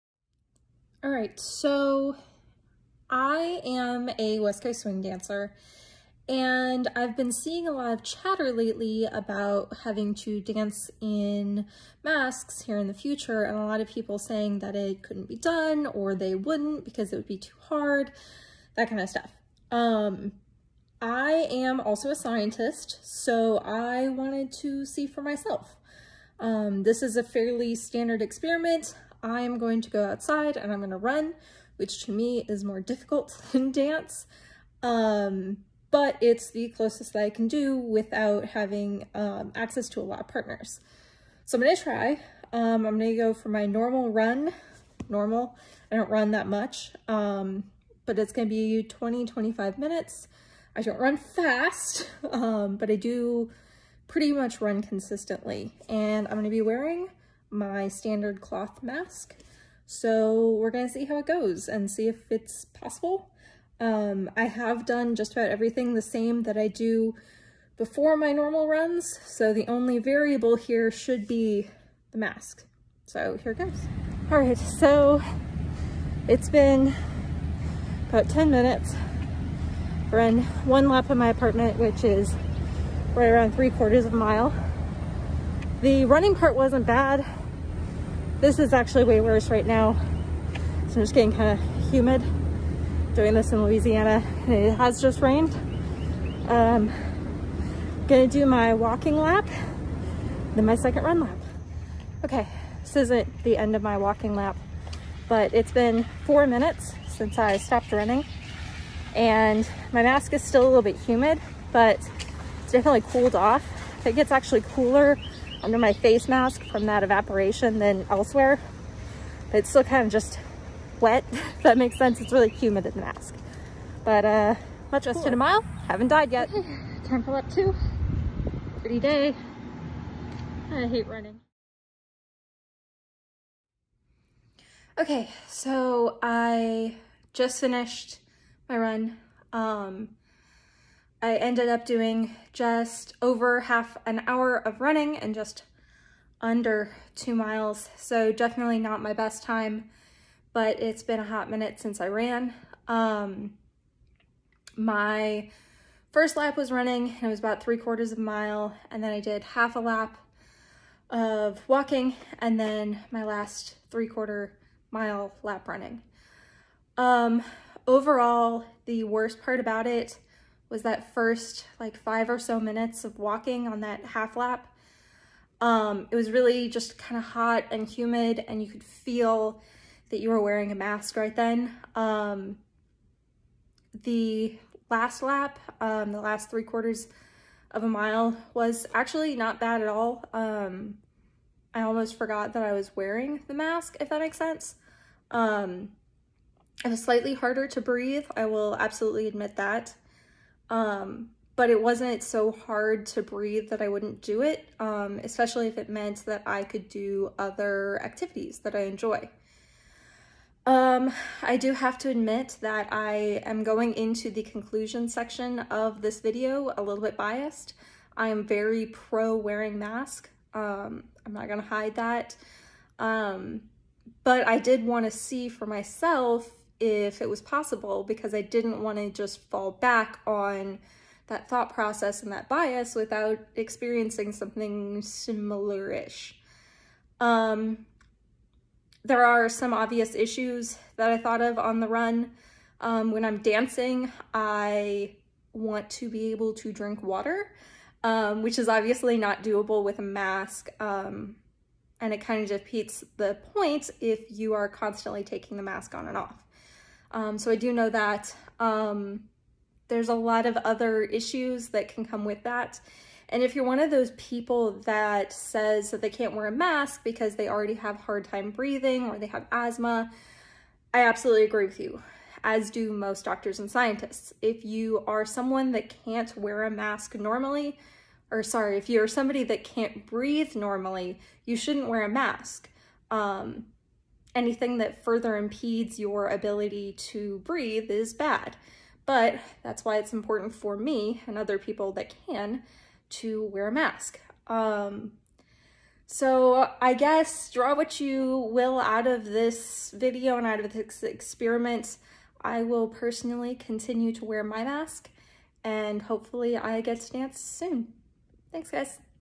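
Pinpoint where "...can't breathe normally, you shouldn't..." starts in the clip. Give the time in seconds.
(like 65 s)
279 s.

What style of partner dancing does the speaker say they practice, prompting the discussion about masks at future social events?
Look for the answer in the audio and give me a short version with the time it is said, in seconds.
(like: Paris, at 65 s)
West Coast swing, at 4 s.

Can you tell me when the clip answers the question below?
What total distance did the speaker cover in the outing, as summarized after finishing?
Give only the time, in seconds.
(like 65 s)
145 s.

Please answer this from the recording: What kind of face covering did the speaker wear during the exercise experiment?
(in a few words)
cloth mask.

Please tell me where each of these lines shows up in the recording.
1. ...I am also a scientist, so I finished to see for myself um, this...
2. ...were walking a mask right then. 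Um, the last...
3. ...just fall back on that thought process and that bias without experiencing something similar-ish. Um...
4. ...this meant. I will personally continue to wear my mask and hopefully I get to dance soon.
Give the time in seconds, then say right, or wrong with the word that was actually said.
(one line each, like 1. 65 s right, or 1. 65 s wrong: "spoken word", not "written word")
1. 21 s wrong: "wanted", not "finished"
2. 180 s wrong: "wearing", not "walking"
3. 229 s right
4. 300 s wrong: "experiment", not "meant".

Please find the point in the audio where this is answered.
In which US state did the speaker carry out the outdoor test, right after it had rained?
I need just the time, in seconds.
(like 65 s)
93 s.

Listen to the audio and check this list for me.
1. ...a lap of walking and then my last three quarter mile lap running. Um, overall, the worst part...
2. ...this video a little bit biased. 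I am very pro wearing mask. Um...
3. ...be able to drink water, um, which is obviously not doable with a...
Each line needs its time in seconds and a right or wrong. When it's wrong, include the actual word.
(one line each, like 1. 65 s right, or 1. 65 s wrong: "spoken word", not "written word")
1. 159 s right
2. 216 s right
3. 246 s right.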